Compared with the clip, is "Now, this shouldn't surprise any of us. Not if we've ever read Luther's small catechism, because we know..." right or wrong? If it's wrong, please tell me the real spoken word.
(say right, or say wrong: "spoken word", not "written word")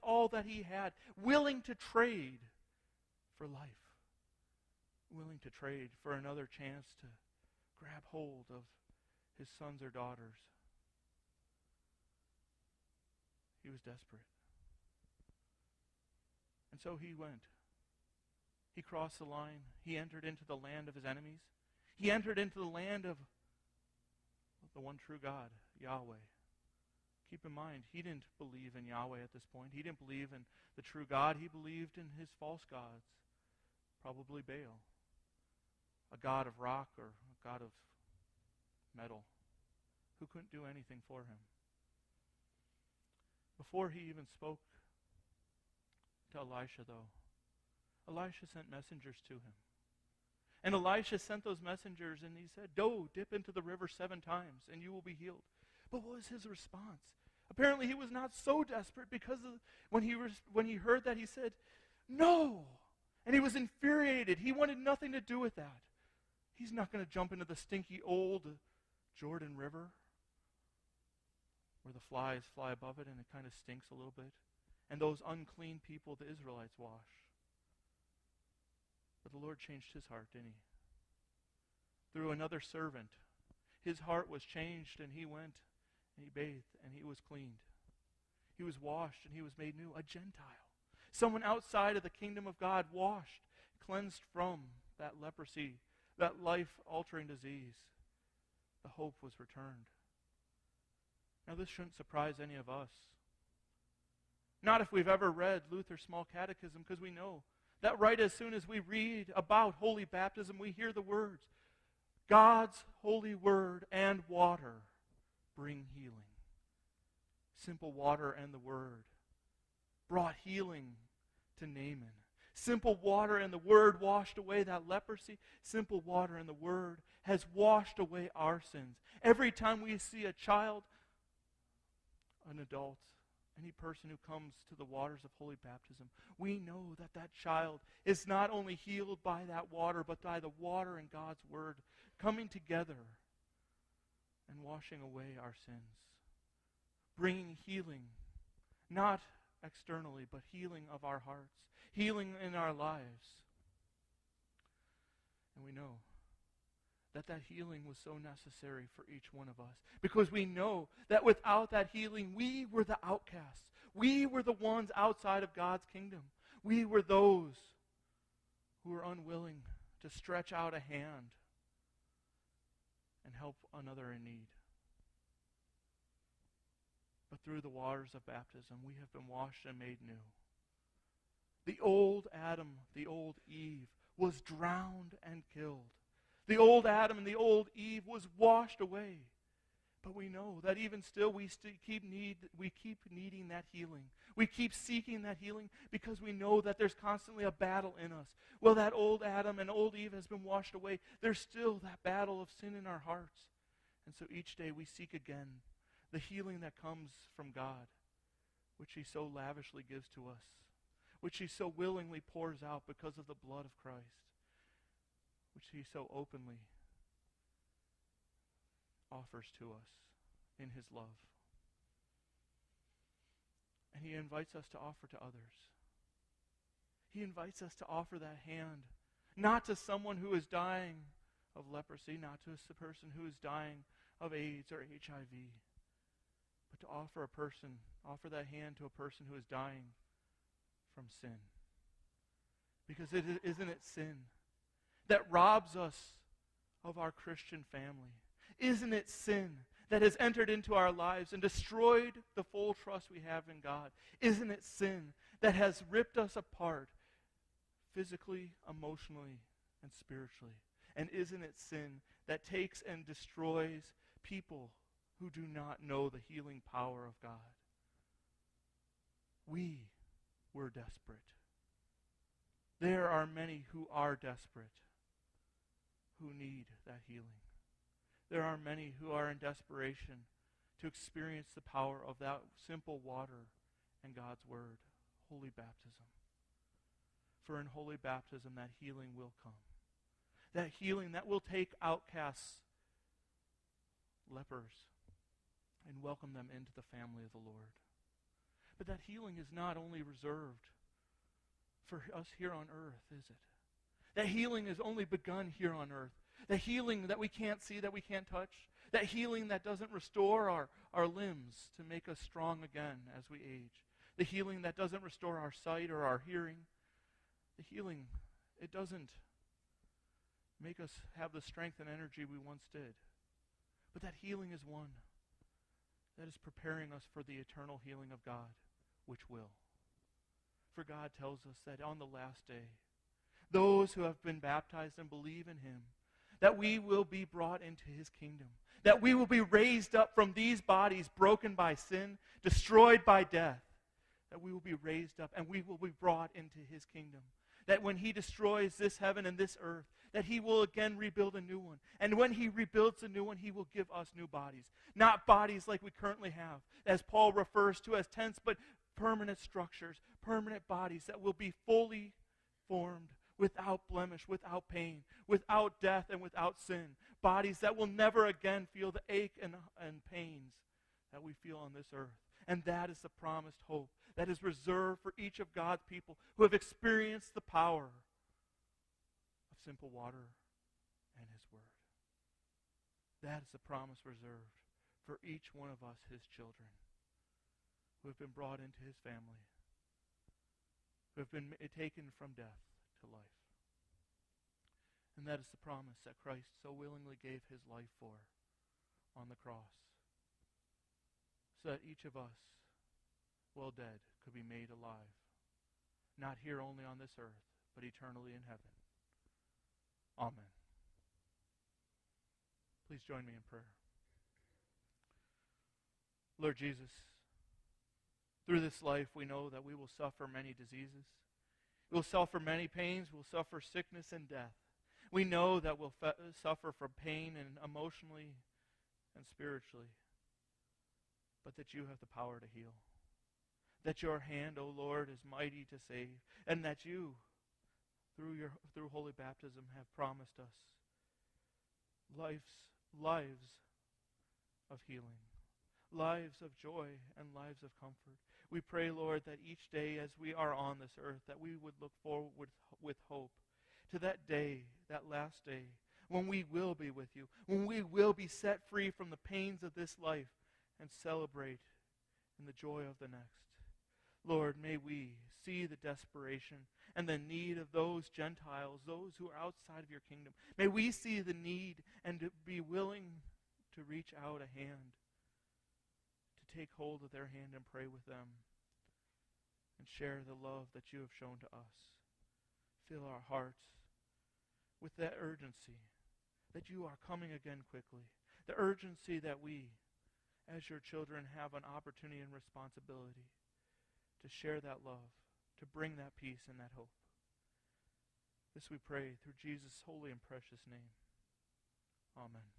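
right.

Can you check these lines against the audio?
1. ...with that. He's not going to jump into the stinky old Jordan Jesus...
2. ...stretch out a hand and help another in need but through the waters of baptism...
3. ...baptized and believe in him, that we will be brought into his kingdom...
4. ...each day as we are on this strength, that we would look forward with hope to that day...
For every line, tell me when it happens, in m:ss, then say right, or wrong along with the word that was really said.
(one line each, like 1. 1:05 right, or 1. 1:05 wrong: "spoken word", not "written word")
1. 1:05 wrong: "River", not "Jesus"
2. 2:50 right
3. 5:34 right
4. 7:29 wrong: "earth", not "strength".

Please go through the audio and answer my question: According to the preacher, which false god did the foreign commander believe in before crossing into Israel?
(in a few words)
Baal.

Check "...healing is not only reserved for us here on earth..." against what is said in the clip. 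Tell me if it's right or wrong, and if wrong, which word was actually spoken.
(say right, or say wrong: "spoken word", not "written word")
right.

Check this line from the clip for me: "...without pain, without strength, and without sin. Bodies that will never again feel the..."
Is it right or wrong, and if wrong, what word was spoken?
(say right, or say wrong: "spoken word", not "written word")
wrong: "death", not "strength".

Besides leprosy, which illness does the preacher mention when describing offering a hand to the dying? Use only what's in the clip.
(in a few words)
AIDS or HIV.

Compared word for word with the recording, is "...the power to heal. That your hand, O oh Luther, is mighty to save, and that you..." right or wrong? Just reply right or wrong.
wrong.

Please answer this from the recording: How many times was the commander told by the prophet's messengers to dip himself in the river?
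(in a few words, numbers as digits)
7.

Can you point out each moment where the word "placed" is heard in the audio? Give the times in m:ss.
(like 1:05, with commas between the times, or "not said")
not said.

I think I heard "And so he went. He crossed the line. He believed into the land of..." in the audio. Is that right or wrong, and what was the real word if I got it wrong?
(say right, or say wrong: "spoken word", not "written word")
wrong: "entered", not "believed".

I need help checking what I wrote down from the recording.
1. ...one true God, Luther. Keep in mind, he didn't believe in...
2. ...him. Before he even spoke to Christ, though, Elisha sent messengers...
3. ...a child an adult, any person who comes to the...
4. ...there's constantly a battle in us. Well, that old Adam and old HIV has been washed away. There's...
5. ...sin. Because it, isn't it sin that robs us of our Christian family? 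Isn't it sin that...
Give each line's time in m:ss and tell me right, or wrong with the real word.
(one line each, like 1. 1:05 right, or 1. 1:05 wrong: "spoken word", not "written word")
1. 0:24 wrong: "Yahweh", not "Luther"
2. 0:41 wrong: "Elisha", not "Christ"
3. 2:10 right
4. 3:16 wrong: "Eve", not "HIV"
5. 4:01 right.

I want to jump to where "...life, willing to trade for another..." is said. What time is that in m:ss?
0:03.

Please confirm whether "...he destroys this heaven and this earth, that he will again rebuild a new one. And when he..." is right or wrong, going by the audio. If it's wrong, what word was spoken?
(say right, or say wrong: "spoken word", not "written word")
right.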